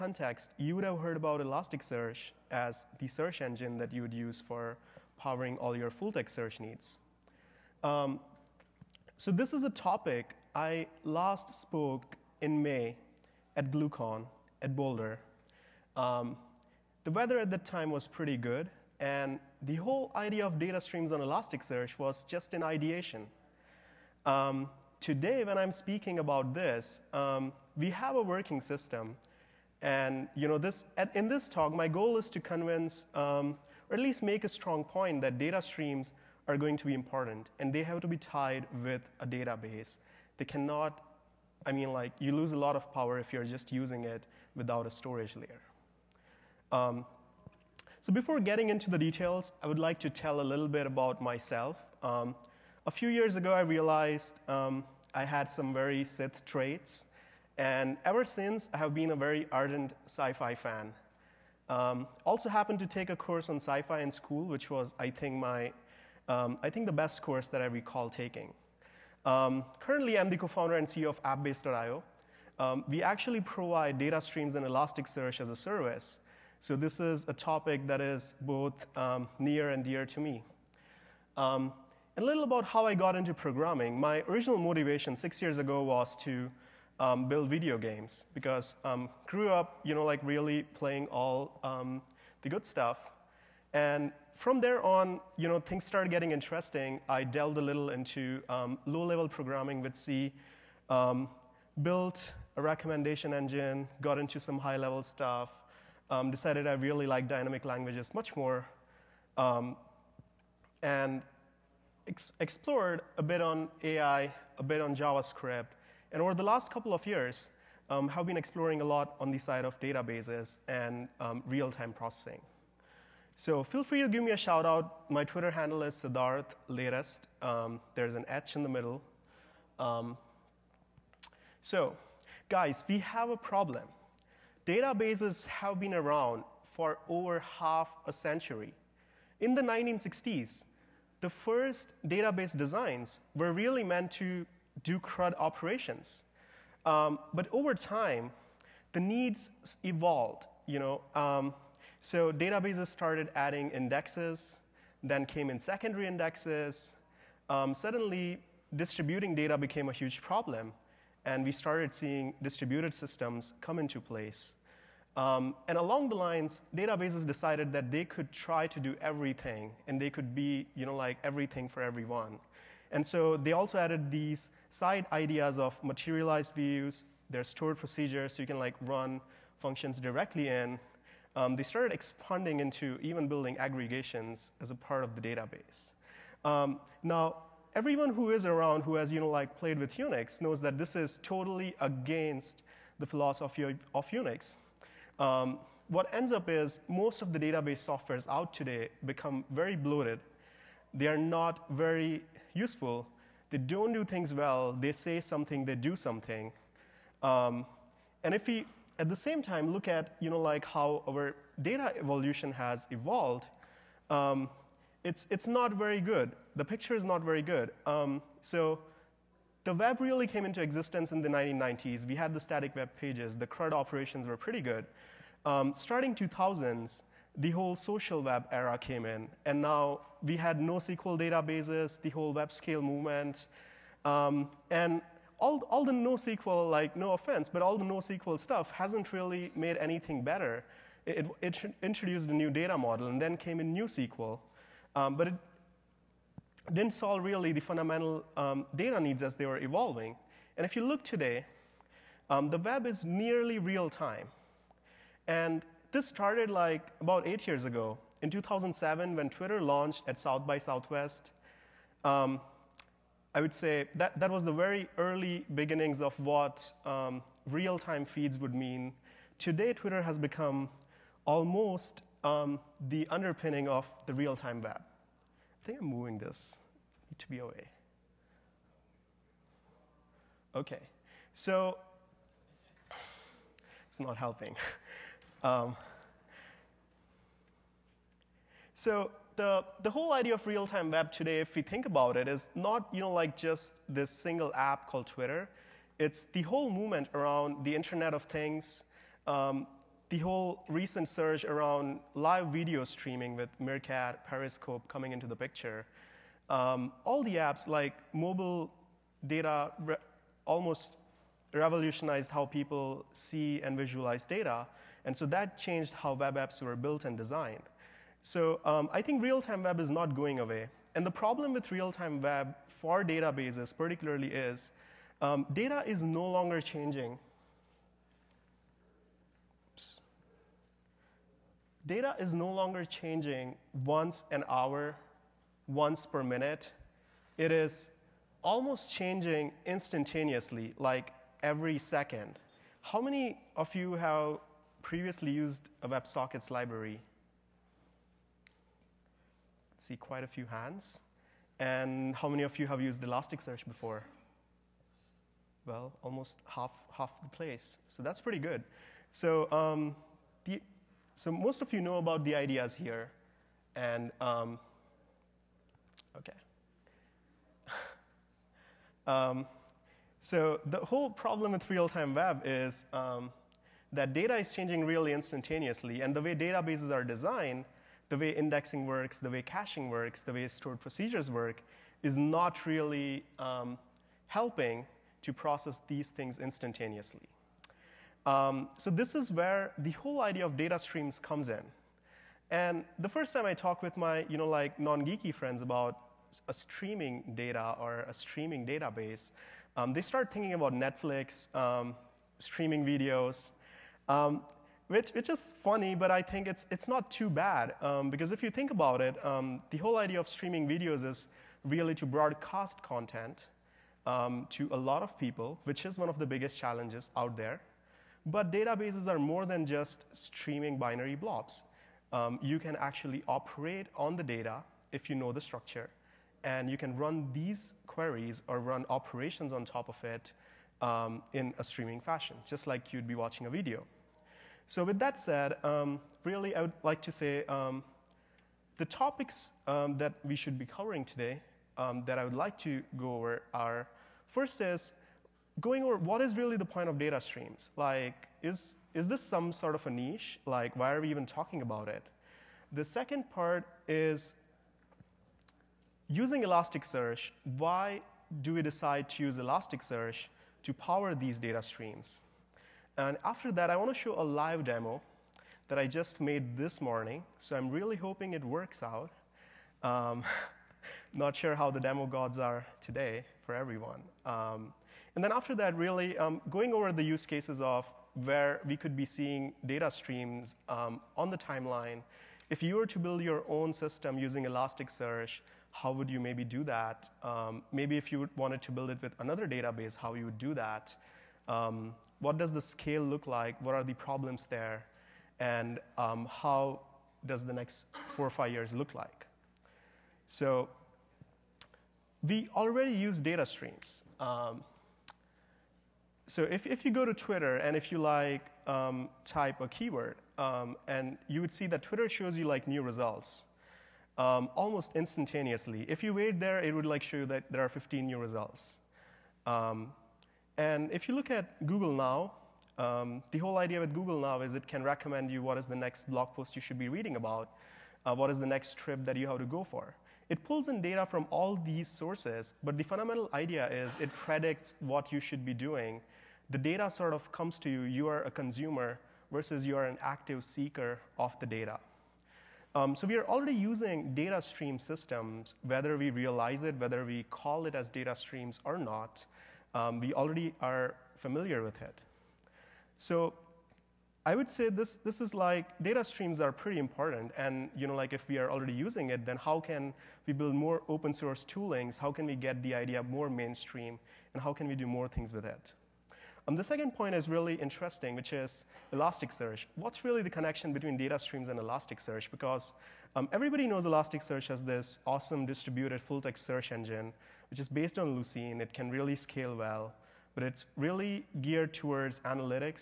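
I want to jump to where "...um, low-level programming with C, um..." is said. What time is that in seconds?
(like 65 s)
98 s.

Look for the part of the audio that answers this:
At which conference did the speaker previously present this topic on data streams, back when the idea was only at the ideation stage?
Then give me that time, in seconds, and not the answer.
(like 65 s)
13 s.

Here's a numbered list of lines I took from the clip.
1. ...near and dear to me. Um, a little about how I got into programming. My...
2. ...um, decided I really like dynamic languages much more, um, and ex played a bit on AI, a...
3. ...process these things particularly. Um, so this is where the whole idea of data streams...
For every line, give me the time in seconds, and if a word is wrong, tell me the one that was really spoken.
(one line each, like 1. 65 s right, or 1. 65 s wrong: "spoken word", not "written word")
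1. 79 s right
2. 106 s wrong: "explored", not "played"
3. 385 s wrong: "instantaneously", not "particularly".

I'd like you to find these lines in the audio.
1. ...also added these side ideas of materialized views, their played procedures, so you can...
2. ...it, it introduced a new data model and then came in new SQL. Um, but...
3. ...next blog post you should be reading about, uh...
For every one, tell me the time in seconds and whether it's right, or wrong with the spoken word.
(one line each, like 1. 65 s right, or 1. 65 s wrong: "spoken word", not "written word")
1. 173 s wrong: "stored", not "played"
2. 241 s right
3. 525 s right.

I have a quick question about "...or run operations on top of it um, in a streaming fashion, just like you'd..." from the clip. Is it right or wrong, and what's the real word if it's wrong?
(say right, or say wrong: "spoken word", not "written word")
right.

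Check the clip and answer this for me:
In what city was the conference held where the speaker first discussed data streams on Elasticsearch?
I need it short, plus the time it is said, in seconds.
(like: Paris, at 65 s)
Boulder, at 14 s.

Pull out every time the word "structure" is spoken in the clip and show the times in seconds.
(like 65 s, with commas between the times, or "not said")
425 s.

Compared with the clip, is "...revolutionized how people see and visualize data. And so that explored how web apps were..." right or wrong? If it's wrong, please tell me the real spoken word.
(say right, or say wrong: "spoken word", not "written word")
wrong: "changed", not "explored".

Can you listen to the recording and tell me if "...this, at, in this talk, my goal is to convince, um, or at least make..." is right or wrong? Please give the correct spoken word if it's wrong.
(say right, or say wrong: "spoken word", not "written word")
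right.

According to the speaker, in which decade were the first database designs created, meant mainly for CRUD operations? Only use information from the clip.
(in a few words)
1960s.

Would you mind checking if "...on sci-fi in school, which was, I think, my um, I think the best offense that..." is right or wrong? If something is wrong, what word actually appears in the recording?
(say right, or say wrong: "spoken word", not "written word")
wrong: "course", not "offense".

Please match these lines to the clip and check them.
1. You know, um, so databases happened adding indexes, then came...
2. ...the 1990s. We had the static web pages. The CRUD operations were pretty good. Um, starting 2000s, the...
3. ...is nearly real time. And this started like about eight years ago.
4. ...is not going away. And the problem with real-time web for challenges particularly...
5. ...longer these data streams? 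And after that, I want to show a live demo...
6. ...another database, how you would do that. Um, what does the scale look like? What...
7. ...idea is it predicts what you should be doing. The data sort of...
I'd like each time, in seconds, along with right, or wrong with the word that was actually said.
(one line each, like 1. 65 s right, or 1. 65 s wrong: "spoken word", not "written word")
1. 150 s wrong: "started", not "happened"
2. 221 s right
3. 252 s right
4. 319 s wrong: "databases", not "challenges"
5. 460 s wrong: "power", not "longer"
6. 489 s right
7. 533 s right.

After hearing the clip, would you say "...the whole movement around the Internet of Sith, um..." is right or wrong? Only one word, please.
wrong.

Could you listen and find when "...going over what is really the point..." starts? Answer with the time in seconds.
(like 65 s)
445 s.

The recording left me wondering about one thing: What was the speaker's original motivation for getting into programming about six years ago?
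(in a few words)
build video games.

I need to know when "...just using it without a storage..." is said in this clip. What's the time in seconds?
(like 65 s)
43 s.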